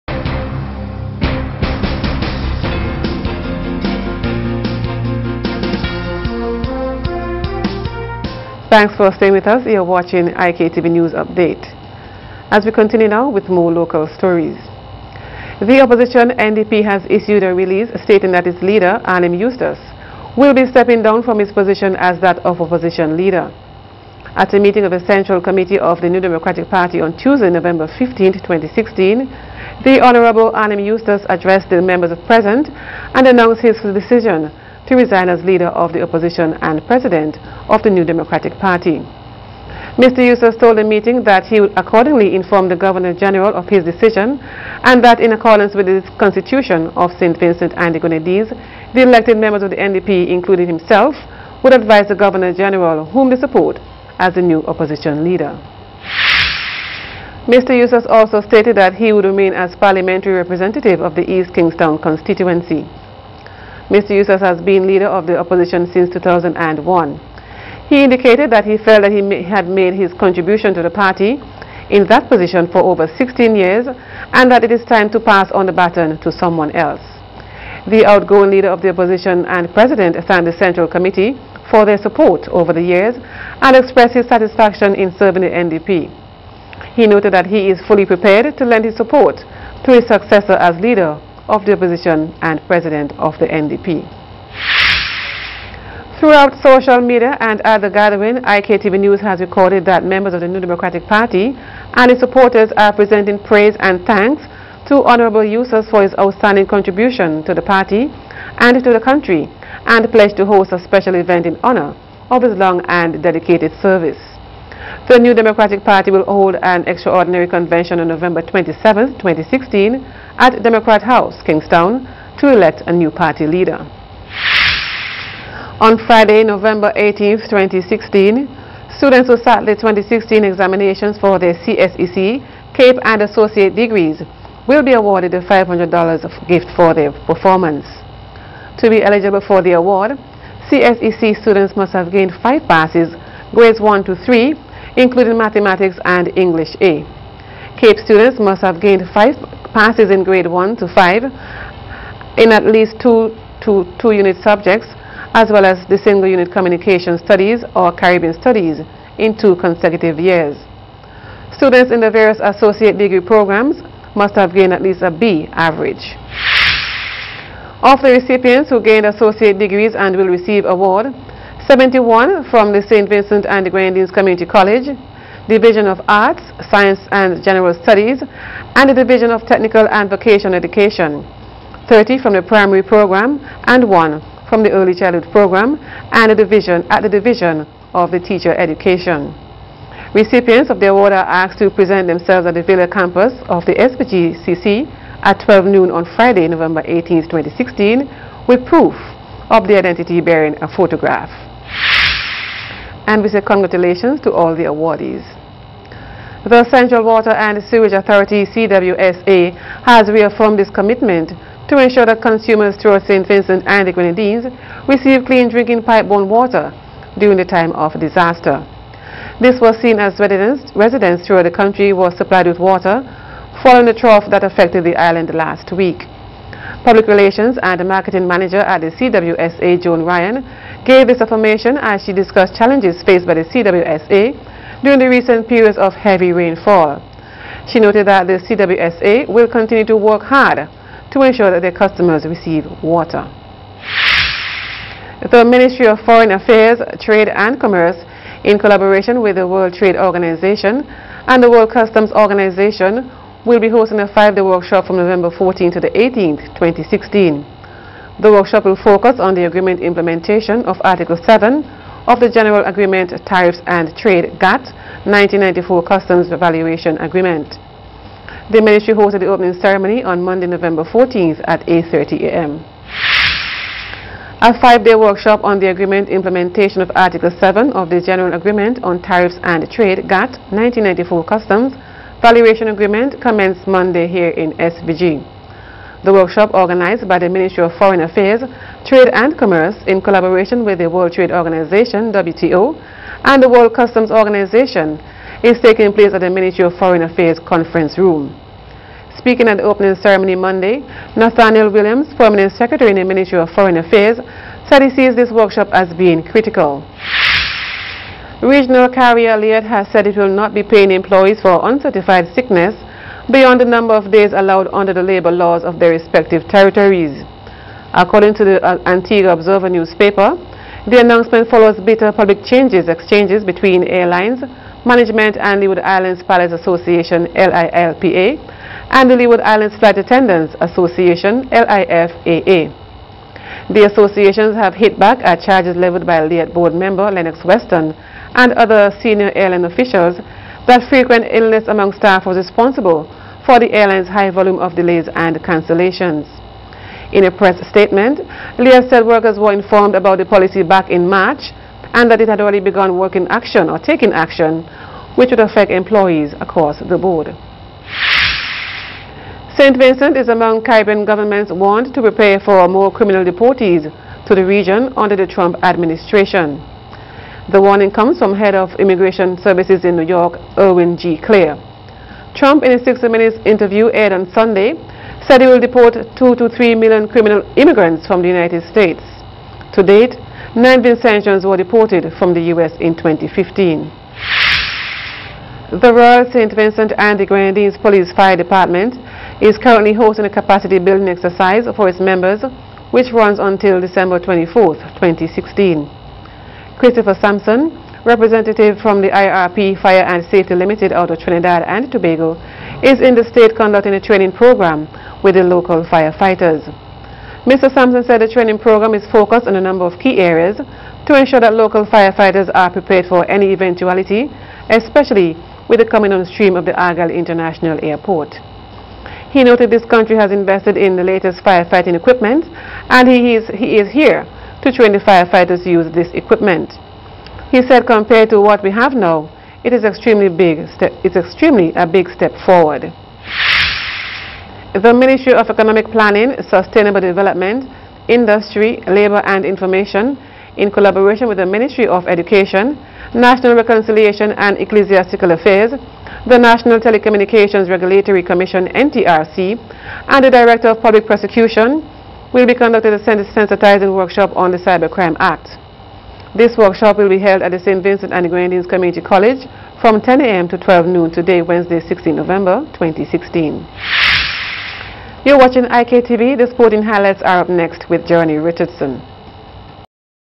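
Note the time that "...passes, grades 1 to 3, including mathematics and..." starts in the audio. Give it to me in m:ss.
2:22.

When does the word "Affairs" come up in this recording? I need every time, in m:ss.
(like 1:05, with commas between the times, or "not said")
4:06, 4:48, 4:57, 5:03, 7:25.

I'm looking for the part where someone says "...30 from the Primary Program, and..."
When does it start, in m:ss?
3:01.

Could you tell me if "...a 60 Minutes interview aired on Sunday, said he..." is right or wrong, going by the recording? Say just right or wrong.
right.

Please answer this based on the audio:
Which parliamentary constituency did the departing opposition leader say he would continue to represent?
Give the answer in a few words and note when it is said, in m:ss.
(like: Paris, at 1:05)
East Kingston, at 1:01.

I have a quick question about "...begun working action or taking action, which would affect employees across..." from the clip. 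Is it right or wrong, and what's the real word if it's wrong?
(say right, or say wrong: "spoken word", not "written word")
right.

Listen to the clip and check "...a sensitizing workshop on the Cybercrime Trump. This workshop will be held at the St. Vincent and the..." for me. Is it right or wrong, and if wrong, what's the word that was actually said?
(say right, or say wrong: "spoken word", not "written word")
wrong: "Act", not "Trump".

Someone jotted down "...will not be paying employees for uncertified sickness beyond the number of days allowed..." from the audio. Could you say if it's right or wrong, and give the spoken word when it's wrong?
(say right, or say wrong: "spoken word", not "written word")
right.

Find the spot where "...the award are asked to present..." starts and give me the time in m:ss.
3:10.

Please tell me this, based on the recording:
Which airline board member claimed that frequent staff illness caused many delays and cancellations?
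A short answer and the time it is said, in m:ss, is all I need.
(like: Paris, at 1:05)
Lennox Weston, at 5:37.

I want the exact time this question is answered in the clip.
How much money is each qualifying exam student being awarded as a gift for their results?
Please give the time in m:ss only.
2:15.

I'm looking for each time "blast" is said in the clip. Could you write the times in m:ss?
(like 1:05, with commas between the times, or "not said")
not said.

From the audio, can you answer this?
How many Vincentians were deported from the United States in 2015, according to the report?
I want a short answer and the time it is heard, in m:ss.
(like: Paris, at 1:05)
19, at 6:20.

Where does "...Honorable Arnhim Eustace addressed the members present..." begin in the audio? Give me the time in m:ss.
0:30.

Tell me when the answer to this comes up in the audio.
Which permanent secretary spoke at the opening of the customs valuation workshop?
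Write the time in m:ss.
5:01.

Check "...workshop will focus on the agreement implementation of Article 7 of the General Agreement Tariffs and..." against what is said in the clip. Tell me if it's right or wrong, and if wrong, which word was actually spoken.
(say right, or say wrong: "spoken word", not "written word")
right.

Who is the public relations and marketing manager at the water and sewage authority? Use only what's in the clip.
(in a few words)
Joan Ryan.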